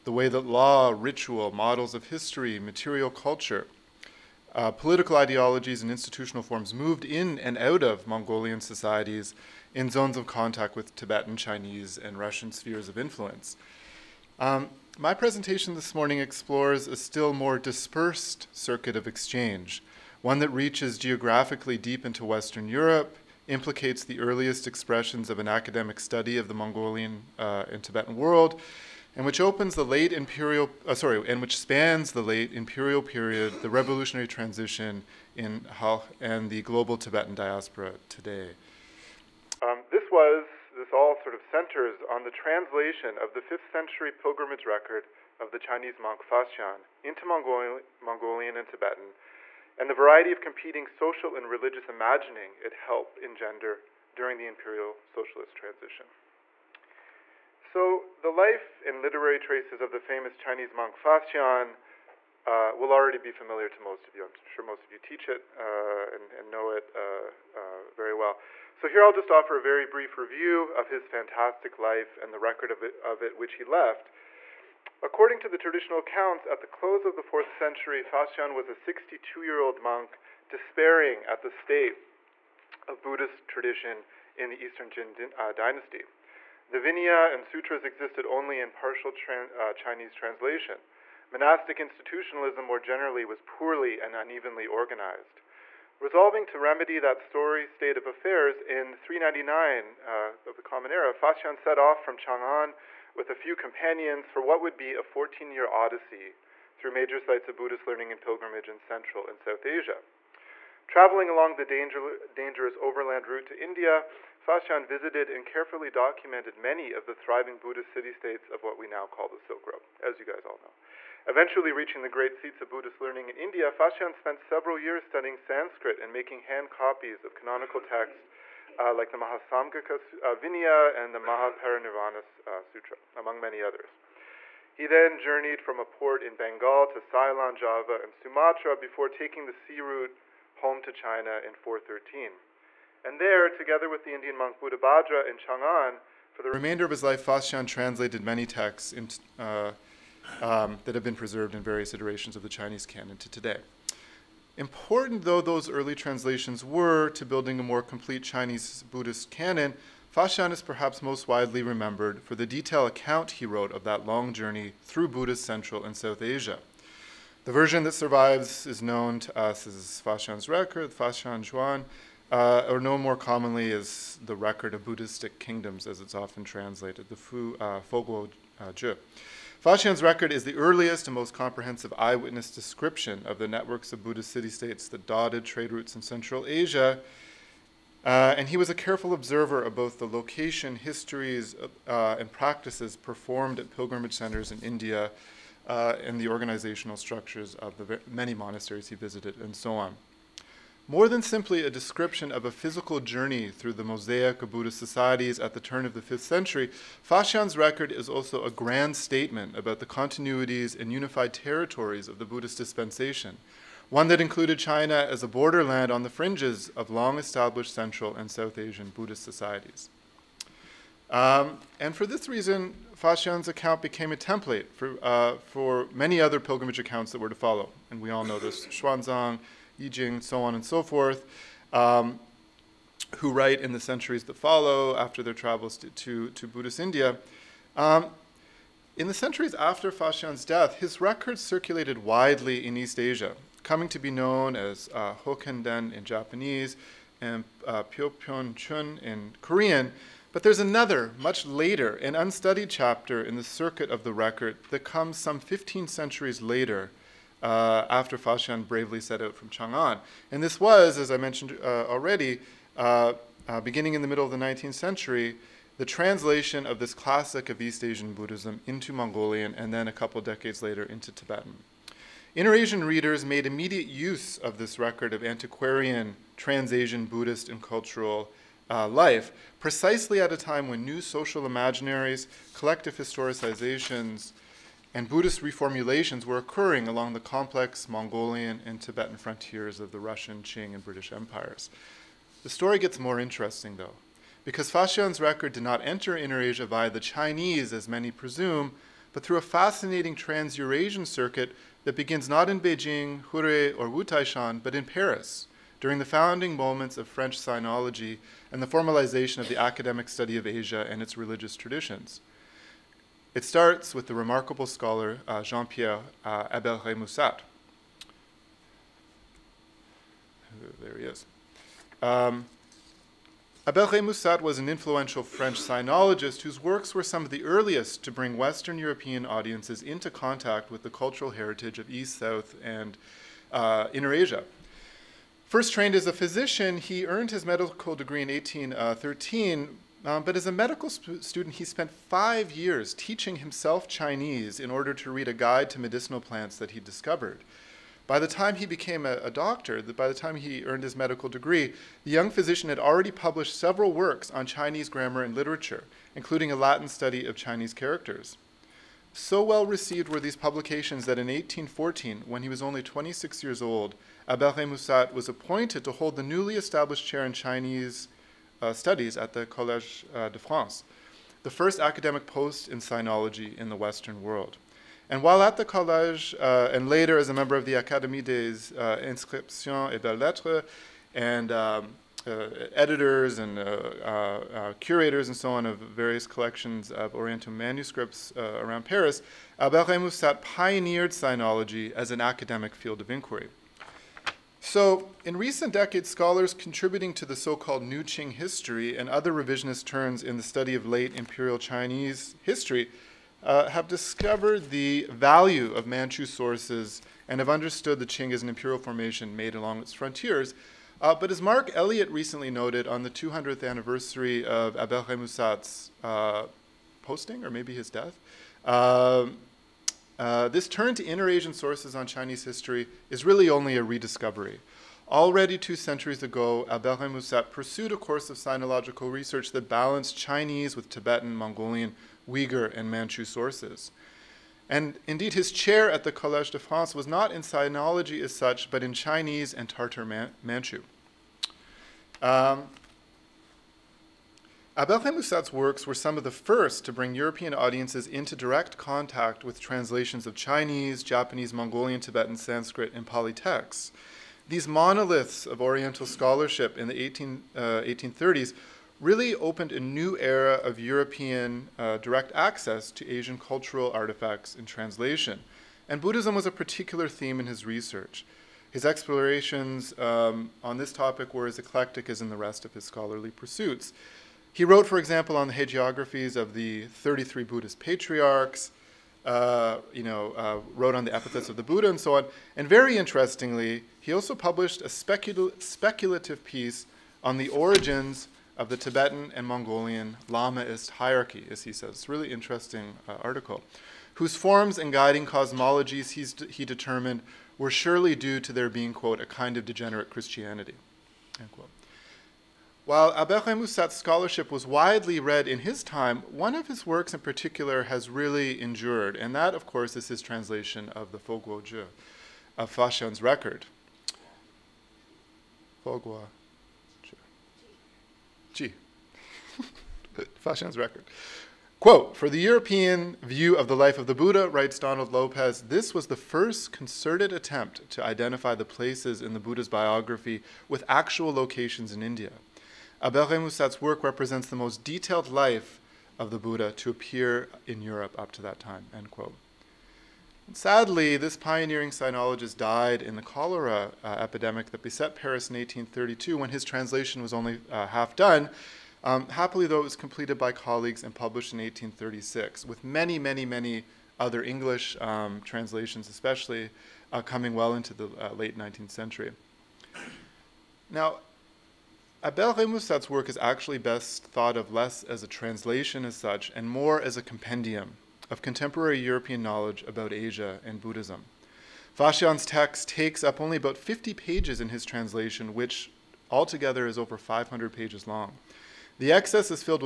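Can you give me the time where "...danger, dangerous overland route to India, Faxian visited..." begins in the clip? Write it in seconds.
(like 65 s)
111 s.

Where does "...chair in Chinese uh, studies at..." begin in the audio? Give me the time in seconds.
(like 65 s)
367 s.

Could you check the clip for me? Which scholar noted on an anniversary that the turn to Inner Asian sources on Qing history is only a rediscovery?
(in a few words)
Mark Elliott.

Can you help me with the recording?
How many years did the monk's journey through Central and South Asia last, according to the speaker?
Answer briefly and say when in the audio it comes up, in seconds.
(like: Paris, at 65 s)
14, at 105 s.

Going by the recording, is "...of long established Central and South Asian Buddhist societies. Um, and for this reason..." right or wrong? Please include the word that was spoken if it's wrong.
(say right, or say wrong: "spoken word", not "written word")
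right.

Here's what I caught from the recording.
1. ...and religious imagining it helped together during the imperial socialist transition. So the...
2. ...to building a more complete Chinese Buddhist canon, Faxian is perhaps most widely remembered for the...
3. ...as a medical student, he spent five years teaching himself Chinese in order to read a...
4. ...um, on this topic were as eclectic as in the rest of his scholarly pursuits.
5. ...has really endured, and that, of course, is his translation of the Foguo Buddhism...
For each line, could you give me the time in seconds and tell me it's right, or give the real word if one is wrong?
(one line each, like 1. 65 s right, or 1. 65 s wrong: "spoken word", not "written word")
1. 51 s wrong: "engender", not "together"
2. 157 s right
3. 340 s right
4. 469 s right
5. 507 s wrong: "Jue", not "Buddhism".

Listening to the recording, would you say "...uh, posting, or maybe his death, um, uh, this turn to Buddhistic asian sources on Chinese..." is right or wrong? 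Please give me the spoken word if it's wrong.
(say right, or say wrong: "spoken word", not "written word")
wrong: "Inner", not "Buddhistic".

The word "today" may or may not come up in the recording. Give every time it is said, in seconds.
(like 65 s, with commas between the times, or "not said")
38 s, 153 s.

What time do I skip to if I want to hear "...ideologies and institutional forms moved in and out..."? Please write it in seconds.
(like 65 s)
5 s.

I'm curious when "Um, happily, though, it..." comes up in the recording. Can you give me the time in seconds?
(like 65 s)
549 s.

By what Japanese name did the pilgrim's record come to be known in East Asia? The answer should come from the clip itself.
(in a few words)
Hokenden.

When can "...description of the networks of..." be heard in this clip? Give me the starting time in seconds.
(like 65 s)
182 s.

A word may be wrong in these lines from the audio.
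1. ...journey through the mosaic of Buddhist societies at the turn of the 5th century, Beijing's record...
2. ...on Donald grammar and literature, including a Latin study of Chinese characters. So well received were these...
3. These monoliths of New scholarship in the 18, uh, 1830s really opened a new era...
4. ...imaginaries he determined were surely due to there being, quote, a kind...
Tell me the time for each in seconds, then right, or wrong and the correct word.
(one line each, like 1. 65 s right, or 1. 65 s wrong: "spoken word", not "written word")
1. 202 s wrong: "Faxian", not "Beijing"
2. 354 s wrong: "Chinese", not "Donald"
3. 454 s wrong: "Oriental", not "New"
4. 495 s wrong: "cosmologies", not "imaginaries".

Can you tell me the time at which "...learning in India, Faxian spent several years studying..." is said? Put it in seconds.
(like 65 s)
122 s.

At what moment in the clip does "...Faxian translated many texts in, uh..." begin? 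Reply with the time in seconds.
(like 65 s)
147 s.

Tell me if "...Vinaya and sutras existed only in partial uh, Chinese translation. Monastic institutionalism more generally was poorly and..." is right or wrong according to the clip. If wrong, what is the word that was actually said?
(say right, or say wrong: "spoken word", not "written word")
right.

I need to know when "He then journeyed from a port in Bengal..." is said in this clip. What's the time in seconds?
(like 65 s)
134 s.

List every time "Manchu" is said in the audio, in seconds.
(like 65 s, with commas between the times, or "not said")
405 s, 432 s, 440 s.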